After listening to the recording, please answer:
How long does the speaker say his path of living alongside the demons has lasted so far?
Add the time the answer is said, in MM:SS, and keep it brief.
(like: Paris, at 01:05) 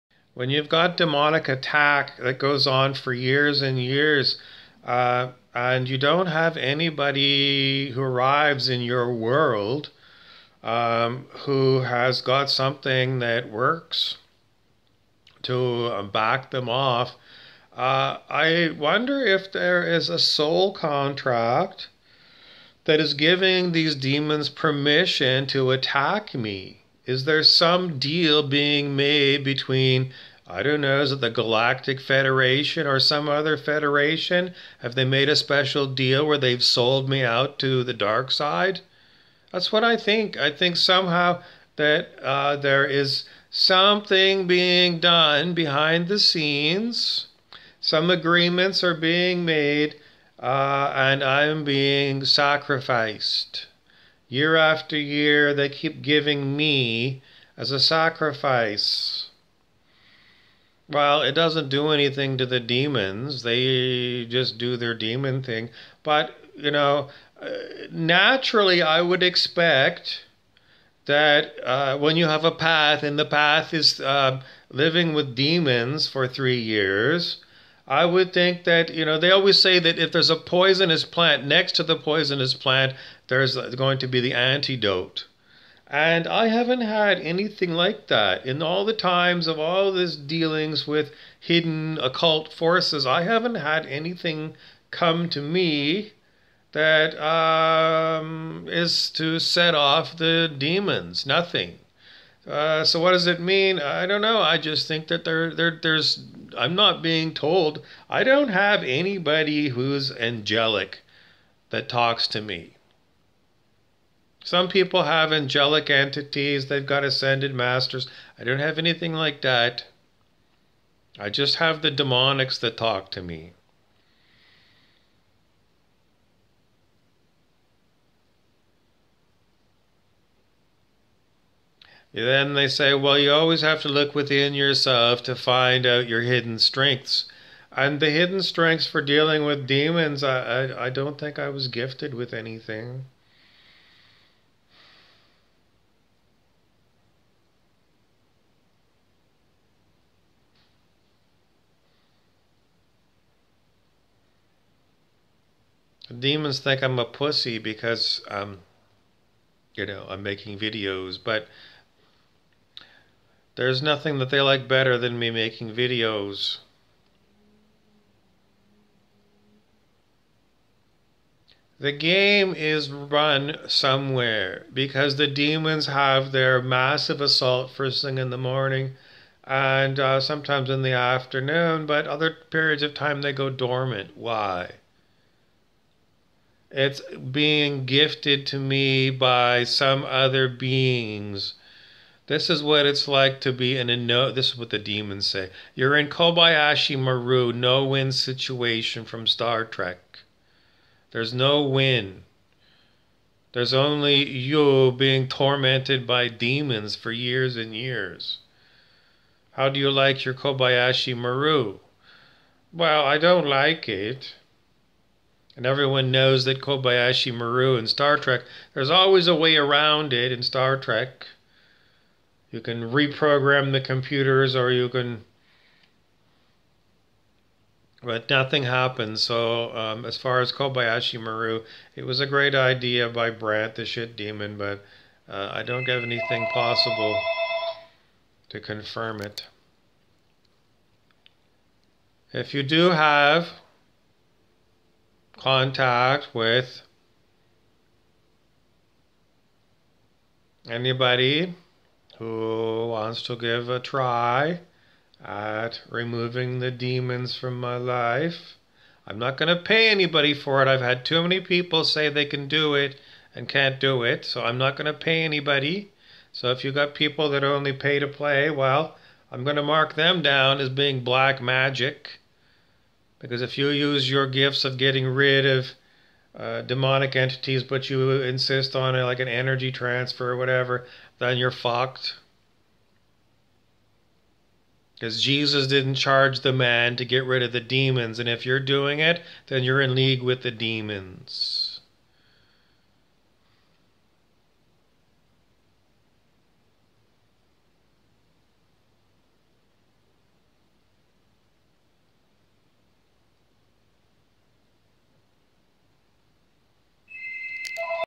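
3 years, at 01:16.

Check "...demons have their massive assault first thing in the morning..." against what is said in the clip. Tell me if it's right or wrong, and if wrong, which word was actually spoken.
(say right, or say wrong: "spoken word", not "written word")
right.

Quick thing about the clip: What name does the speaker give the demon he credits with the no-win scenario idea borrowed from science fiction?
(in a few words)
Brant.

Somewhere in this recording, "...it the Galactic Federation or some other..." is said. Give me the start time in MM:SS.
00:31.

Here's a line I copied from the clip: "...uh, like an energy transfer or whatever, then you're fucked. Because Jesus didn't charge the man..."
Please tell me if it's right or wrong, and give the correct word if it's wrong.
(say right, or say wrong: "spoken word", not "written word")
right.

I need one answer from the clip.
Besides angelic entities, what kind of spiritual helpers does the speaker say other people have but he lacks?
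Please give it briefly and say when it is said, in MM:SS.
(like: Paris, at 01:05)
Ascended masters, at 01:57.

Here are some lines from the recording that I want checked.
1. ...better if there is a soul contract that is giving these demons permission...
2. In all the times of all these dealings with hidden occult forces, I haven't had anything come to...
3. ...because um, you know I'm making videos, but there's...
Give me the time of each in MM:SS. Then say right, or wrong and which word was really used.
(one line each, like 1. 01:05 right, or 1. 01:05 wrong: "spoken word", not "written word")
1. 00:18 wrong: "wonder", not "better"
2. 01:28 right
3. 02:37 right.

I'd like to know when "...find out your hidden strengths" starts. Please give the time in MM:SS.
02:15.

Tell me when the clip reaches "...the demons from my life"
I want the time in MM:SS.
04:16.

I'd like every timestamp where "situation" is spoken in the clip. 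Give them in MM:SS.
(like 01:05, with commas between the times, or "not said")
03:18.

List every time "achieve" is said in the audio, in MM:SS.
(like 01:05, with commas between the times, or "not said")
not said.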